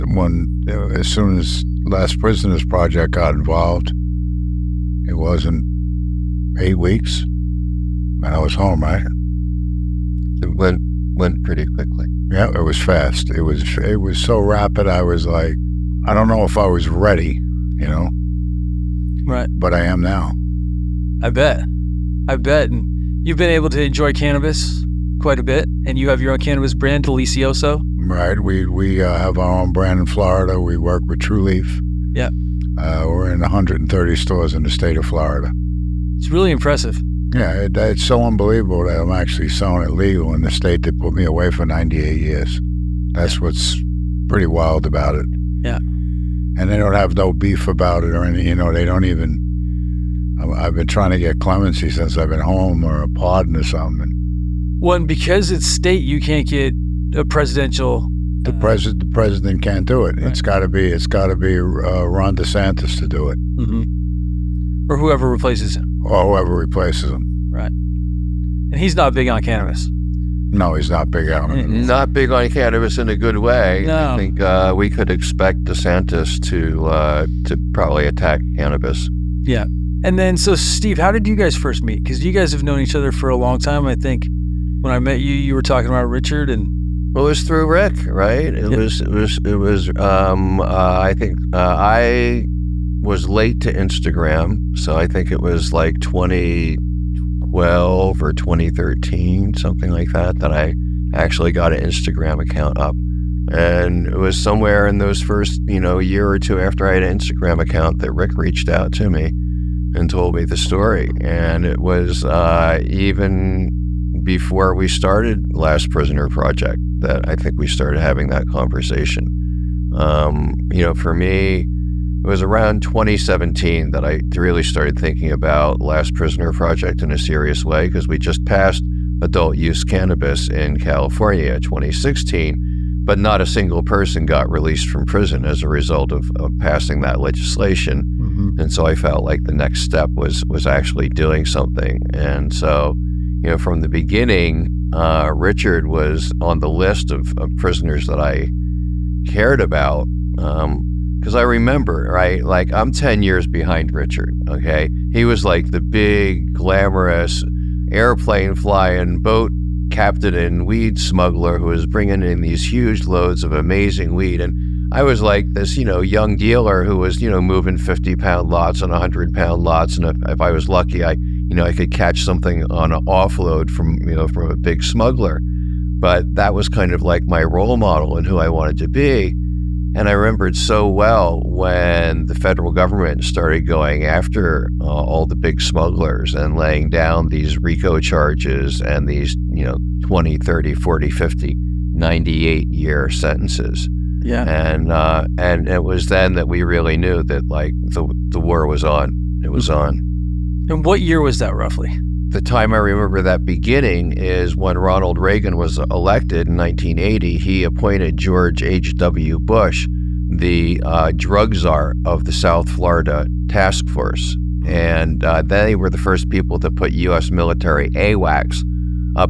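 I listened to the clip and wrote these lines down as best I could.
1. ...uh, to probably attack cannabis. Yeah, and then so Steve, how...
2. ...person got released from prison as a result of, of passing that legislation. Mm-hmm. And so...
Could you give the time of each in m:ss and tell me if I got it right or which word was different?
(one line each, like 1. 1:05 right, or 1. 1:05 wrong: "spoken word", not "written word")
1. 1:16 right
2. 2:13 right.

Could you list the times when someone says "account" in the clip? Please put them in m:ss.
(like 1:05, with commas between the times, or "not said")
1:42, 1:47.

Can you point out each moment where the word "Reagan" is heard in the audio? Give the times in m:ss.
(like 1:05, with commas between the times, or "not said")
3:25.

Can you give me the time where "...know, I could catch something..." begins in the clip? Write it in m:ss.
2:51.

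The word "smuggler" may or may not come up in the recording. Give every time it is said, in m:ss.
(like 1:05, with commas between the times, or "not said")
2:40, 2:54, 3:05.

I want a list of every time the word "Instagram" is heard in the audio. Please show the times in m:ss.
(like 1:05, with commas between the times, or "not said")
1:33, 1:41, 1:47.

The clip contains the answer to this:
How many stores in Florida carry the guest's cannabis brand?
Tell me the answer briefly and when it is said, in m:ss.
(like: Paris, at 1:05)
130, at 0:33.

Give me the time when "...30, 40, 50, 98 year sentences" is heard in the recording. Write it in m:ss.
3:10.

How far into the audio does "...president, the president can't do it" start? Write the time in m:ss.
0:58.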